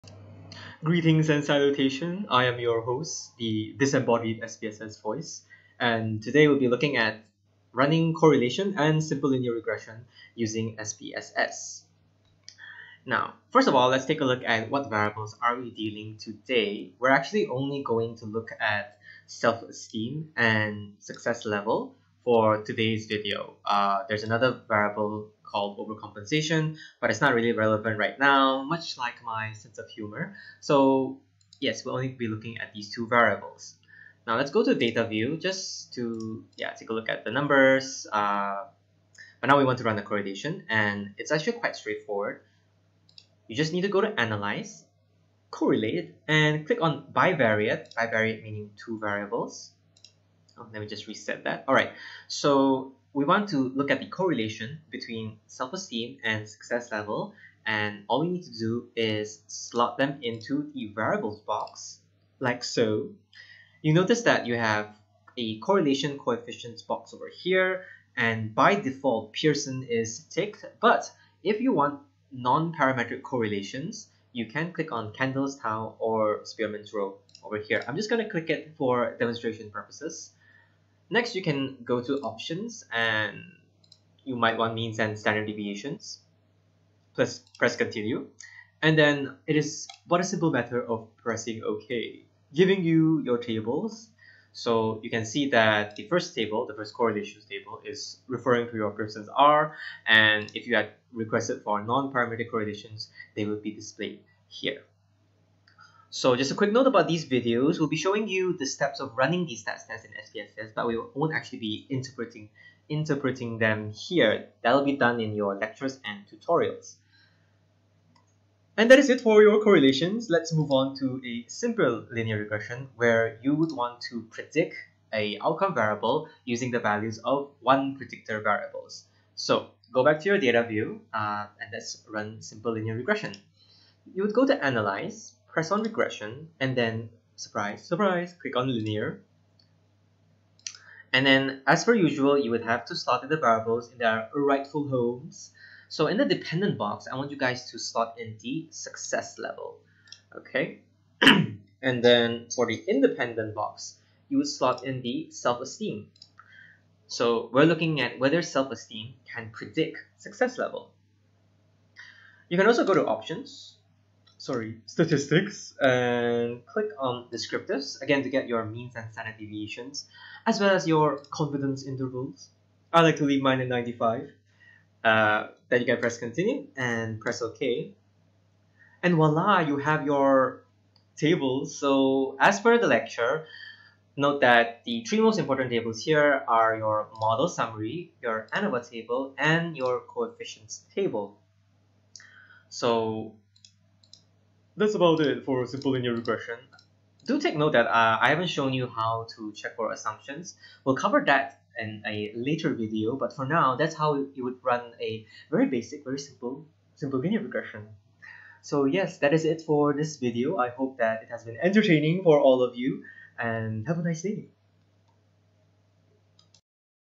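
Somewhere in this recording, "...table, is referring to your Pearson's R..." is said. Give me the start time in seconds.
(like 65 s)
97 s.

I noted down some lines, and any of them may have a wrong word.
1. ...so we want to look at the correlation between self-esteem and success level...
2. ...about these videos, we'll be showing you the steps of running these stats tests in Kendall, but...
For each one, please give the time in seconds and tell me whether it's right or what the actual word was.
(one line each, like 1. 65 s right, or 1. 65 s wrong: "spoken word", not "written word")
1. 52 s right
2. 106 s wrong: "SPSS", not "Kendall".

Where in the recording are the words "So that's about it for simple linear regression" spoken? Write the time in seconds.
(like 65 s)
192 s.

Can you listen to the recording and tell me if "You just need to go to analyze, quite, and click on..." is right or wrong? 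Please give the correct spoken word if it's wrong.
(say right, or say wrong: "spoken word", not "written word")
wrong: "correlate", not "quite".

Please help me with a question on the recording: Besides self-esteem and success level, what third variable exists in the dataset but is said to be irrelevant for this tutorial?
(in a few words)
Overcompensation.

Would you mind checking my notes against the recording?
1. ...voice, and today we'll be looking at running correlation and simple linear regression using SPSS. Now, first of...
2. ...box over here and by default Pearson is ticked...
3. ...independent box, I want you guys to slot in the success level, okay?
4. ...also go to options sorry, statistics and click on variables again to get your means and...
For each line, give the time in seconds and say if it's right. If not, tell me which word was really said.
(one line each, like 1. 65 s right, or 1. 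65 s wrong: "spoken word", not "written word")
1. 5 s right
2. 66 s right
3. 146 s wrong: "dependent", not "independent"
4. 162 s wrong: "descriptives", not "variables".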